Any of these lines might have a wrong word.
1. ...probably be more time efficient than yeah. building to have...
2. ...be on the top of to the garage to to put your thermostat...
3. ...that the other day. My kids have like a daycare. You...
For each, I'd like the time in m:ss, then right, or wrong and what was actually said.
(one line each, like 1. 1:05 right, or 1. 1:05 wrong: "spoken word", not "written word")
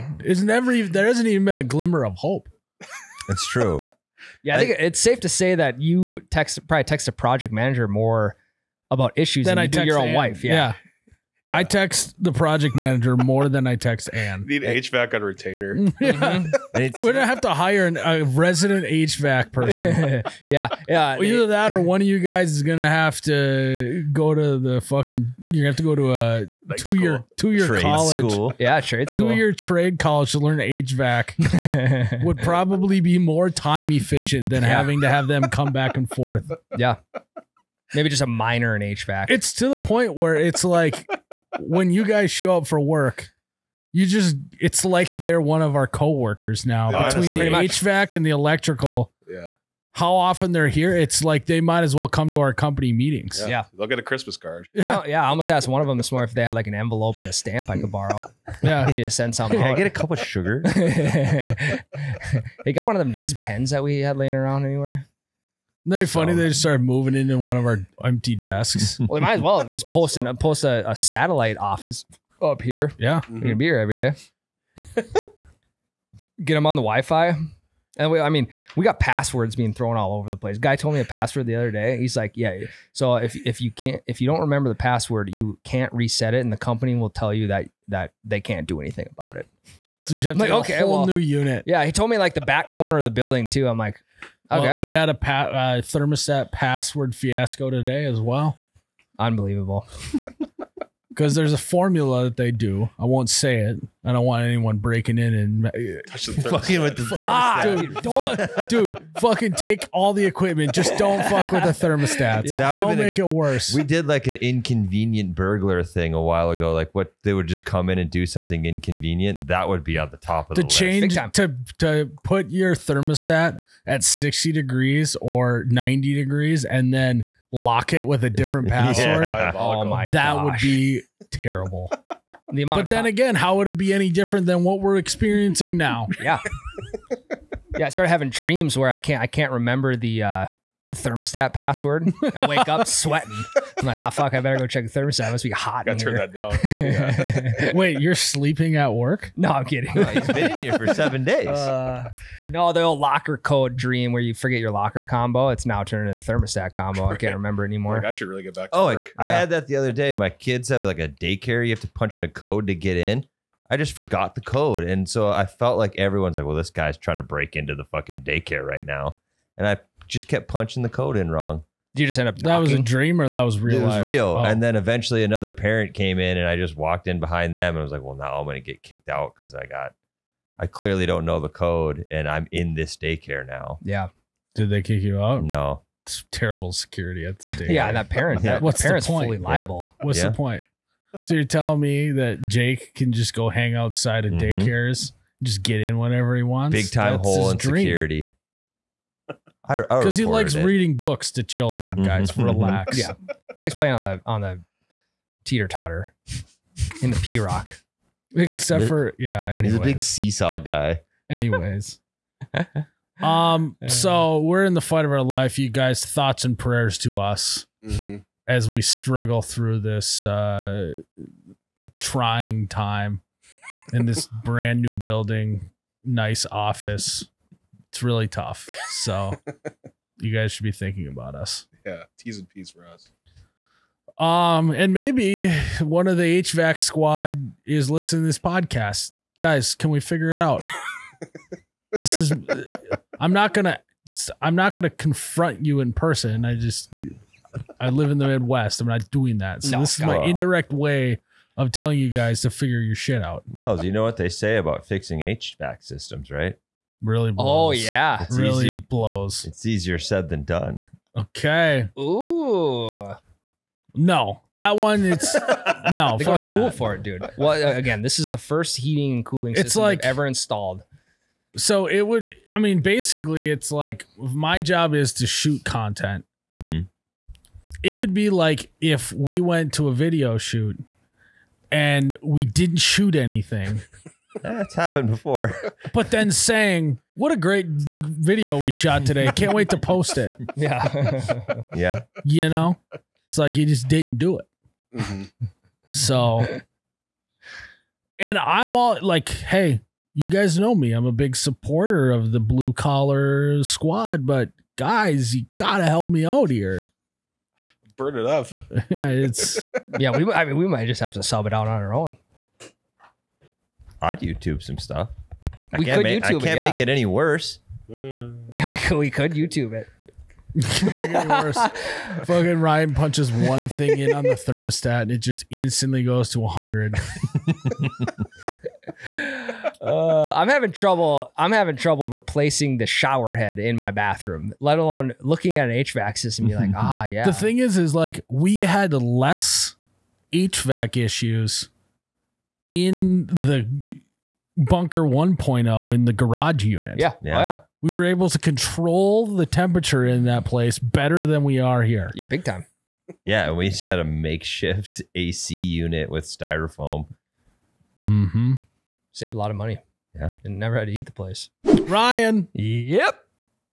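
1. 0:32 wrong: "having", not "building"
2. 1:59 wrong: "change", not "garage"
3. 2:39 right.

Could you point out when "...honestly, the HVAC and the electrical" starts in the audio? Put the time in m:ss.
0:47.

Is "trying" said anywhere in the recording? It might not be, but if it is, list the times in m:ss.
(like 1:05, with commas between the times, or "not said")
2:46, 3:41.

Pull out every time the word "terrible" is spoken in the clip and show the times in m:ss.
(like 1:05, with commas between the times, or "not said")
2:11, 3:06.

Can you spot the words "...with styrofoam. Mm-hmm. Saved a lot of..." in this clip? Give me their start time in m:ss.
5:56.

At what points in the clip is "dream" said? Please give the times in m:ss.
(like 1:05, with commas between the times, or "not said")
2:18, 2:33, 2:52, 3:17.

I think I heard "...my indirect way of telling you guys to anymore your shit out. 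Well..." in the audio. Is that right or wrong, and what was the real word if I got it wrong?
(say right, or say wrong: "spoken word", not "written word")
wrong: "figure", not "anymore".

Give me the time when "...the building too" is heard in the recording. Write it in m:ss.
1:33.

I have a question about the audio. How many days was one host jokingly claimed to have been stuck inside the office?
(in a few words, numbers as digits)
7.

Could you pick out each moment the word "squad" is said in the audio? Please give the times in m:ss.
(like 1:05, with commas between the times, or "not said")
3:56, 5:03.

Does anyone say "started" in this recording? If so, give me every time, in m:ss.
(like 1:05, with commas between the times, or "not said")
1:06, 2:17.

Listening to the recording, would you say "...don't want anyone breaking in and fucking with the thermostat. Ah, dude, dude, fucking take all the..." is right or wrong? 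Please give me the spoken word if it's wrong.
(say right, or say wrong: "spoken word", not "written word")
right.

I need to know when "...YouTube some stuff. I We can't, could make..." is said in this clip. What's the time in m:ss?
5:14.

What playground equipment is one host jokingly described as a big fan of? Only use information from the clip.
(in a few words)
Seesaw.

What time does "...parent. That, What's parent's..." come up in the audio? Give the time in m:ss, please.
3:08.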